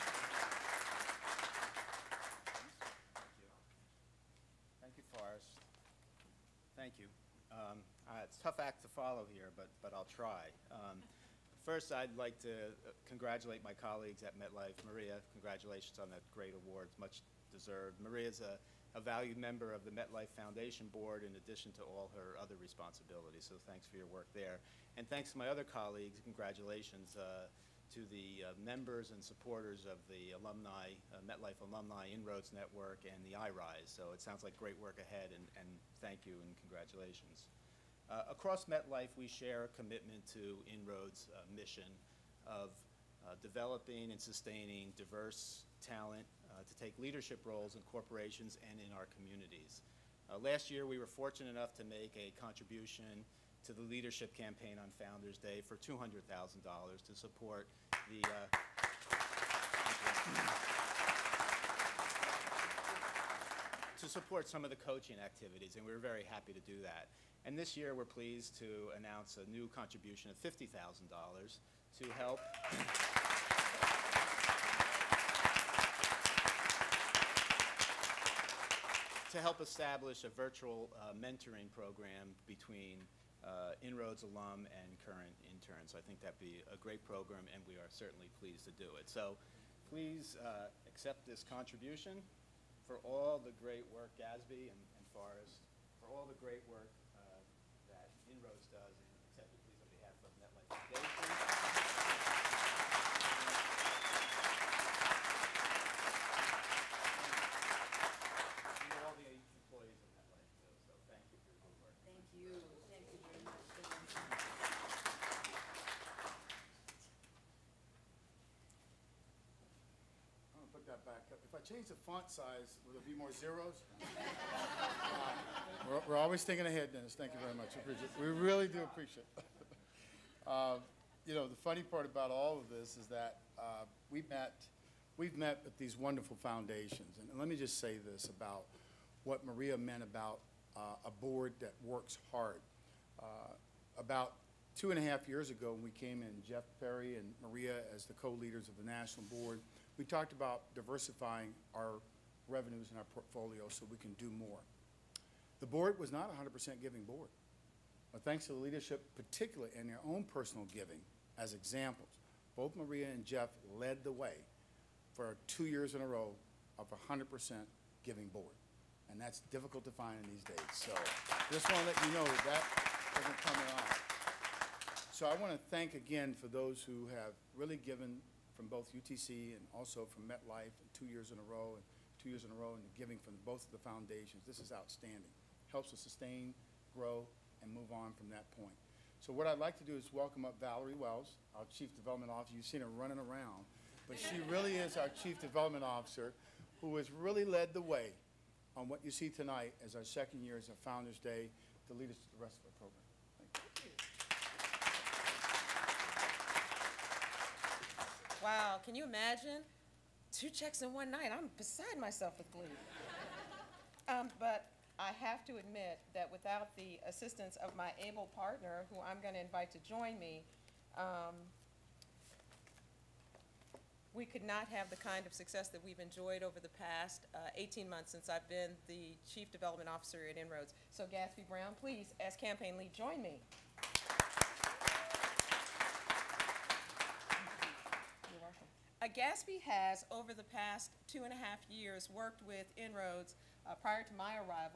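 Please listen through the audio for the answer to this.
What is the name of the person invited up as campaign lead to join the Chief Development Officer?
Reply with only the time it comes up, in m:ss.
3:51.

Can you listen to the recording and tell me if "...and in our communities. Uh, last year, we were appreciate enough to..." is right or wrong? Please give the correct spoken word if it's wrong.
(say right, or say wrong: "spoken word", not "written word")
wrong: "fortunate", not "appreciate".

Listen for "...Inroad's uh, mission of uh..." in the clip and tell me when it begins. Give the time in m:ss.
0:40.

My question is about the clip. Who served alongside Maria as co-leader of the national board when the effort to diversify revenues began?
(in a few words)
Jeff Perry.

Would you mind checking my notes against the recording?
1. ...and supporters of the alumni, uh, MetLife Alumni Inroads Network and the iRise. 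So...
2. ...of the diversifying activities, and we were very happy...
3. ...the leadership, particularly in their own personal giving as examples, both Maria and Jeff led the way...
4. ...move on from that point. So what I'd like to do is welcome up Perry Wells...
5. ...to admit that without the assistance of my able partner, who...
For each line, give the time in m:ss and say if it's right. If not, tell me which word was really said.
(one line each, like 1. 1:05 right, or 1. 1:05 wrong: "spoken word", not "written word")
1. 0:29 right
2. 1:04 wrong: "coaching", not "diversifying"
3. 2:38 right
4. 3:07 wrong: "Valerie", not "Perry"
5. 3:35 right.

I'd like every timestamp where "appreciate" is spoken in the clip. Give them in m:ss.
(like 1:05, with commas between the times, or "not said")
2:08.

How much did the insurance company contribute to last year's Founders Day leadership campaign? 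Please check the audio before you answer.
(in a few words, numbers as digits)
$200,000.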